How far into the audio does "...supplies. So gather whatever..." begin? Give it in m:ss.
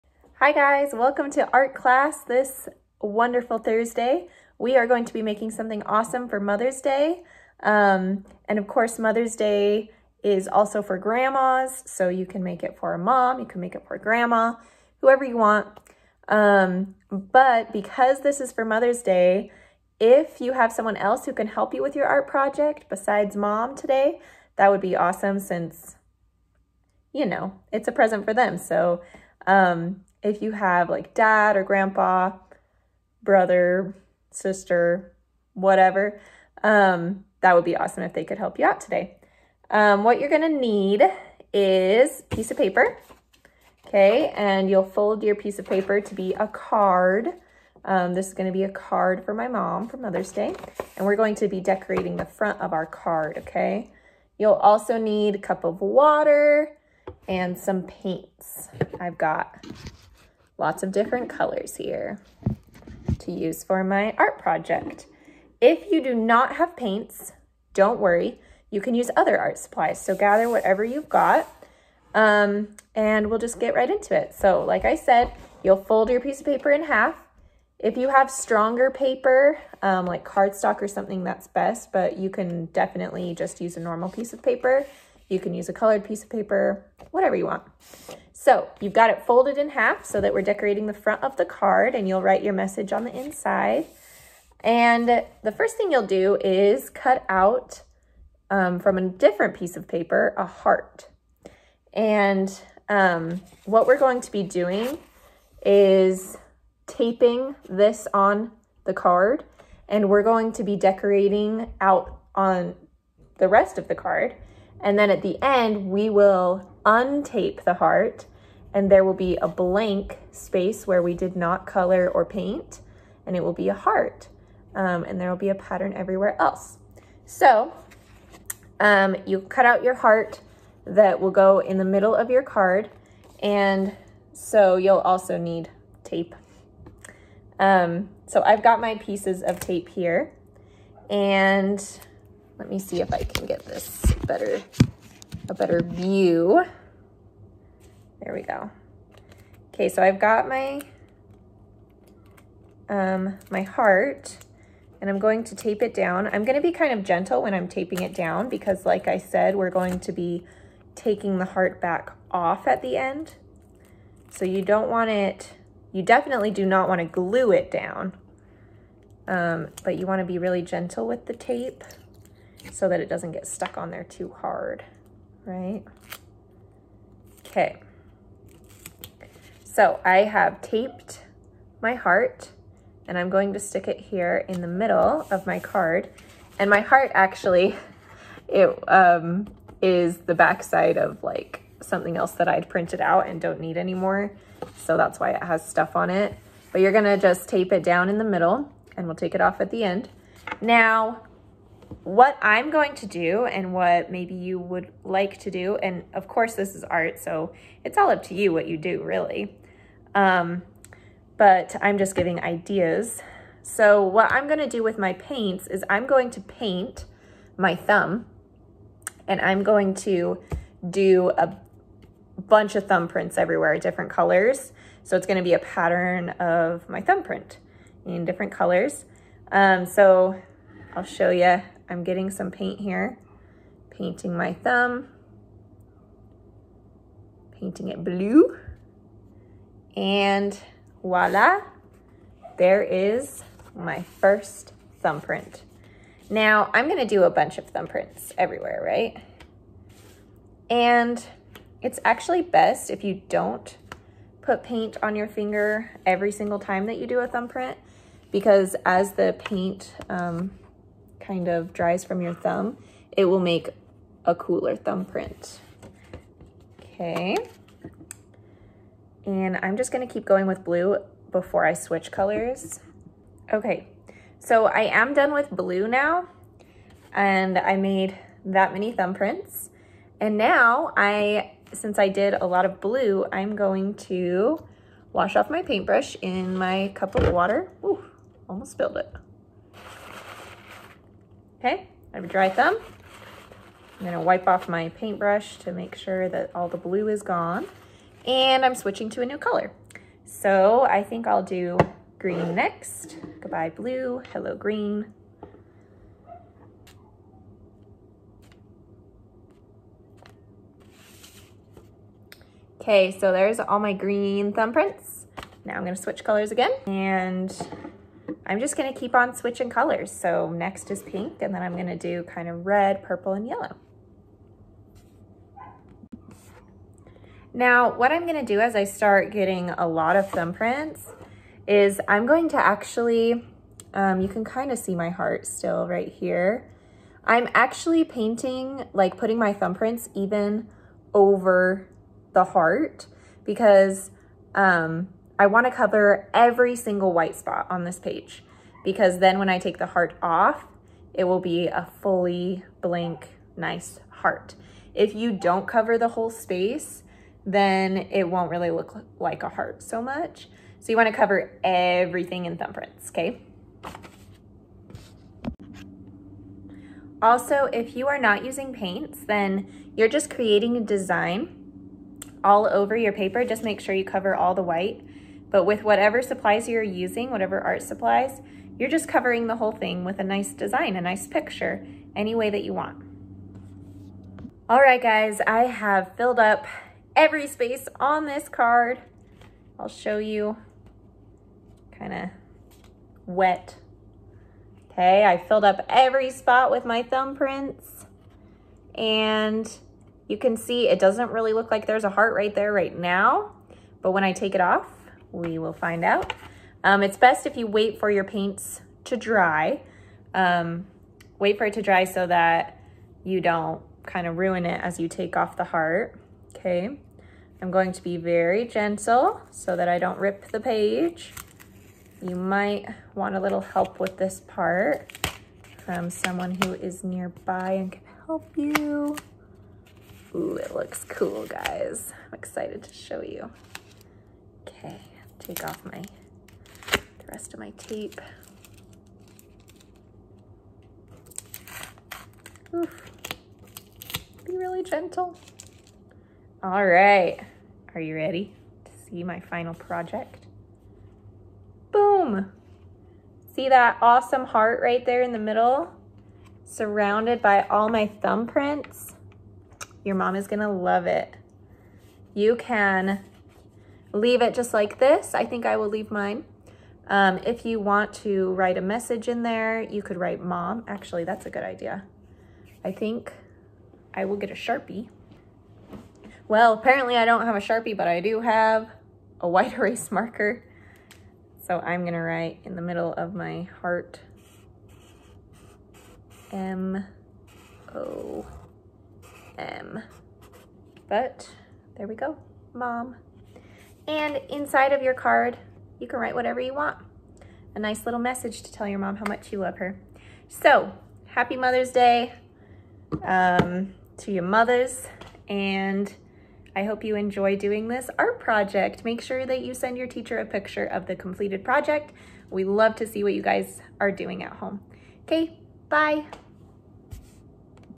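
1:09.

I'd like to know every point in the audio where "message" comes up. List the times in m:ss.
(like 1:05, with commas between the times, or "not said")
1:32, 7:48, 8:18.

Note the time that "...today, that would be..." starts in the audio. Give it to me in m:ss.
0:23.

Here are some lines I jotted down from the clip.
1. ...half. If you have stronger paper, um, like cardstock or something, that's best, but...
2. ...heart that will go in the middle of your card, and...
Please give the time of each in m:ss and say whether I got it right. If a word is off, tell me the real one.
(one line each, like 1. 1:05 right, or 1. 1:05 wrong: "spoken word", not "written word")
1. 1:16 right
2. 2:09 right.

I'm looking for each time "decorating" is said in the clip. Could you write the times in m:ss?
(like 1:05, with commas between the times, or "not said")
0:51, 1:30, 1:50.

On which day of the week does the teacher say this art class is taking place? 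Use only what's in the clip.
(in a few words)
Thursday.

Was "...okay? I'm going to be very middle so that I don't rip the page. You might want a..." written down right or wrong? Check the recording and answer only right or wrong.
wrong.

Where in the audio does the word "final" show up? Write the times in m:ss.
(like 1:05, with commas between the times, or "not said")
7:29.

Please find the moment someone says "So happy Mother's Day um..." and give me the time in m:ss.
8:20.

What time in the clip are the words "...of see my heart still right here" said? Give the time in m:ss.
5:34.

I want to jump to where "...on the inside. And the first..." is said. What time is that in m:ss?
1:32.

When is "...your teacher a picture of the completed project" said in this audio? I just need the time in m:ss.
8:29.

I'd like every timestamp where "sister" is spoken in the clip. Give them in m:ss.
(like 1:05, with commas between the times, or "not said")
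0:34.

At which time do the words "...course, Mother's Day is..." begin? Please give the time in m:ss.
0:08.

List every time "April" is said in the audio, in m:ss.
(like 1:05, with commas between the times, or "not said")
not said.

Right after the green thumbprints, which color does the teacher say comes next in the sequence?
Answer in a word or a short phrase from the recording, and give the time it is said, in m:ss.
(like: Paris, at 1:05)
Pink, at 5:21.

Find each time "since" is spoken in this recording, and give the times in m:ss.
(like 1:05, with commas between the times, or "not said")
0:25, 4:41.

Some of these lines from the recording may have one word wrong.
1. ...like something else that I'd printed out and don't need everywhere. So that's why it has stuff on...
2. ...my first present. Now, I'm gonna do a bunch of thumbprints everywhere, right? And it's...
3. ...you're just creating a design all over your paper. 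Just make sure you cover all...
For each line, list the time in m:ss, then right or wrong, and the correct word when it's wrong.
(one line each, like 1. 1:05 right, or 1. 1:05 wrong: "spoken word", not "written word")
1. 3:11 wrong: "anymore", not "everywhere"
2. 4:03 wrong: "thumbprint", not "present"
3. 6:09 right.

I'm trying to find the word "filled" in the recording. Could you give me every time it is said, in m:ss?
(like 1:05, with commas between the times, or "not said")
6:26, 6:35.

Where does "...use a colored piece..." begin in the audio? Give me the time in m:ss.
1:25.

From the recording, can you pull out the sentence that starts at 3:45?
So it's gonna be a pattern of my thumbprint in different colors.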